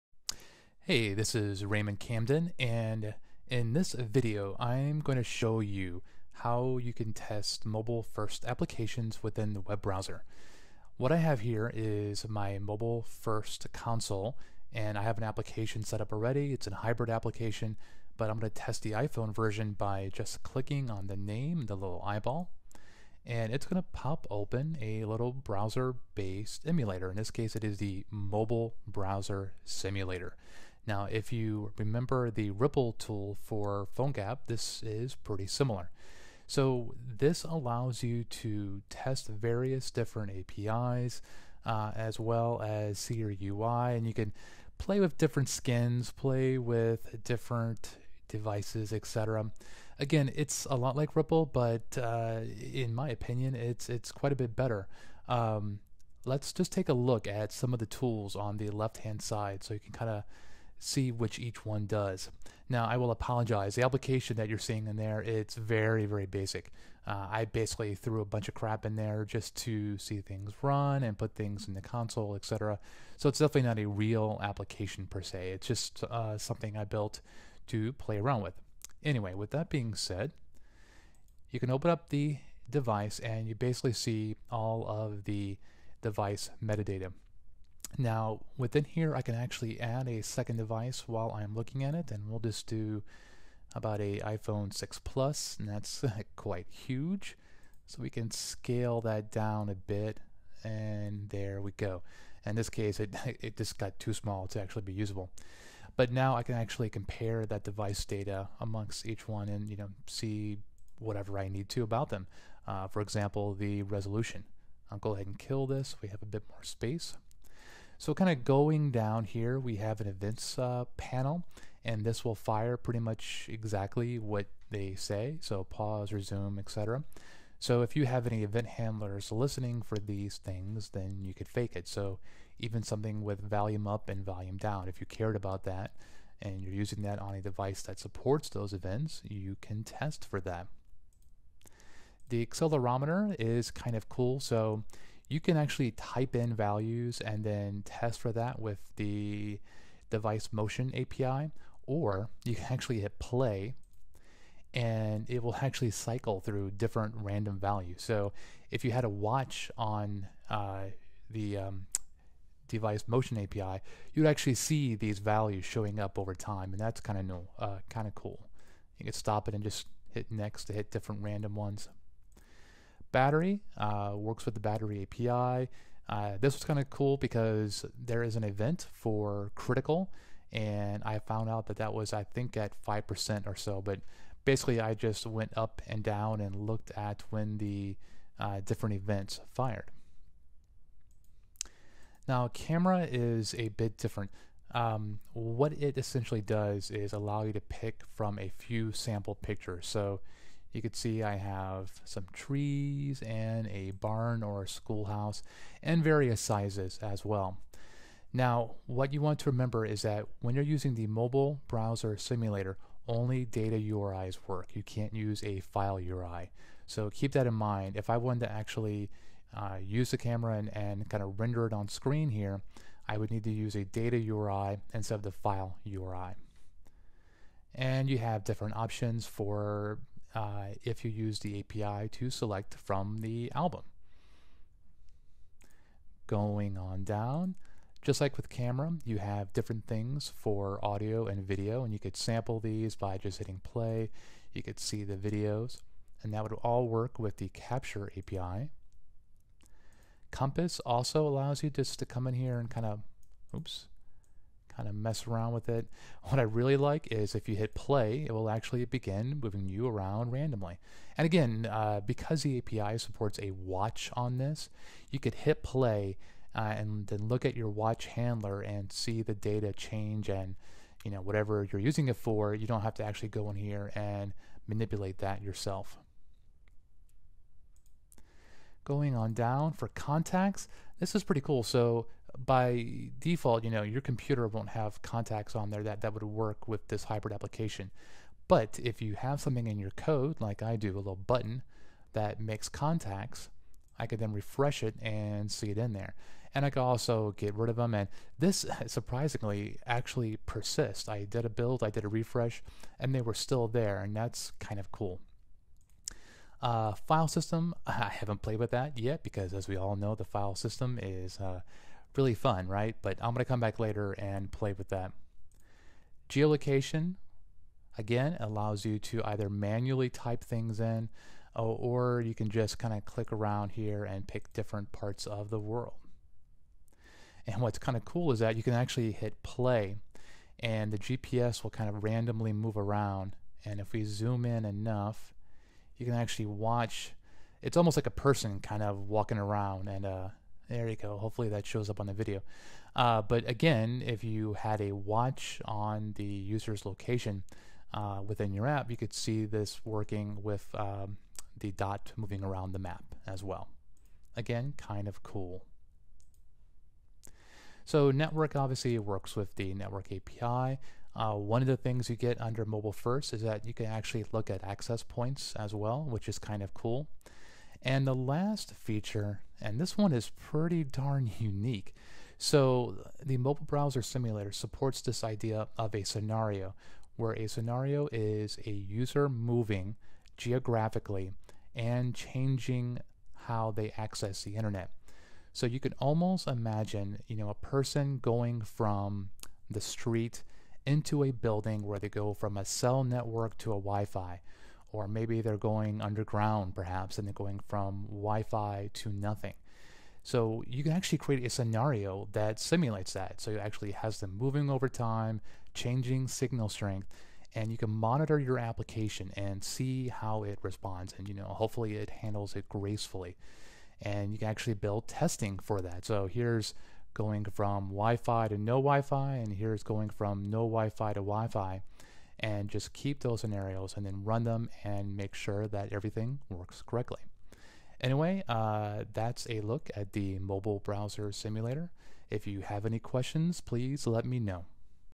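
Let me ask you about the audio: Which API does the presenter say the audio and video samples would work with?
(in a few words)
Capture API.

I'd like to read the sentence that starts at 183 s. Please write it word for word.
But basically, I just went up and down and looked at when the uh, different events fired.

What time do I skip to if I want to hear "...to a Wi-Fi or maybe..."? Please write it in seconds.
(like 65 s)
393 s.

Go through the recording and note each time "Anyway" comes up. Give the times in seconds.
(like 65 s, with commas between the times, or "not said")
79 s, 428 s.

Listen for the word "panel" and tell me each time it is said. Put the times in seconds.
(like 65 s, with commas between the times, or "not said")
120 s.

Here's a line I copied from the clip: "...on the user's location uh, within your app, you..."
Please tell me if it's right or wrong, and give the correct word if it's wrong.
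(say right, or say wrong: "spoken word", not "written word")
right.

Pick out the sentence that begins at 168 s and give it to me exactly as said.
You can stop it and just hit next to hit different random ones battery, uh, works with the battery API.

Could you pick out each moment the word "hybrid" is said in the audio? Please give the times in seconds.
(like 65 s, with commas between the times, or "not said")
16 s, 287 s.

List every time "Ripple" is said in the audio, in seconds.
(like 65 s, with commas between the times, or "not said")
32 s, 51 s.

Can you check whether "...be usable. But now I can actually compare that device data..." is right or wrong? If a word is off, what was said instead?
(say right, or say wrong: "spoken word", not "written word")
right.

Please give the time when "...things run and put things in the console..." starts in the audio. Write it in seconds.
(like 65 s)
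70 s.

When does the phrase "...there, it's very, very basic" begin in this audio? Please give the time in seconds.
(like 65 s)
64 s.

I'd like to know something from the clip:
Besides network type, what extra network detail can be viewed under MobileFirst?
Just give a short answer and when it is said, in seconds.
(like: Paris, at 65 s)
access points, at 364 s.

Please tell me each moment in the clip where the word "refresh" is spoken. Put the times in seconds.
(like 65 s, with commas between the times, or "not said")
294 s, 302 s.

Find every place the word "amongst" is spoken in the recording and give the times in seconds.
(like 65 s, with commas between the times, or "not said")
108 s.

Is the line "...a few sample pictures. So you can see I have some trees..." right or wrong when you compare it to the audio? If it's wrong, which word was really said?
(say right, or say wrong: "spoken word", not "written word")
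right.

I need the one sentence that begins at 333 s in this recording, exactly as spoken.
And if we zoom in enough, you can actually watch.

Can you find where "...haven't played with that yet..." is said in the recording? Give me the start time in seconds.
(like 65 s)
308 s.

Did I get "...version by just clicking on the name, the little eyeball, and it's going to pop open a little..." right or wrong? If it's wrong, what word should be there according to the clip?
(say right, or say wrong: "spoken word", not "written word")
right.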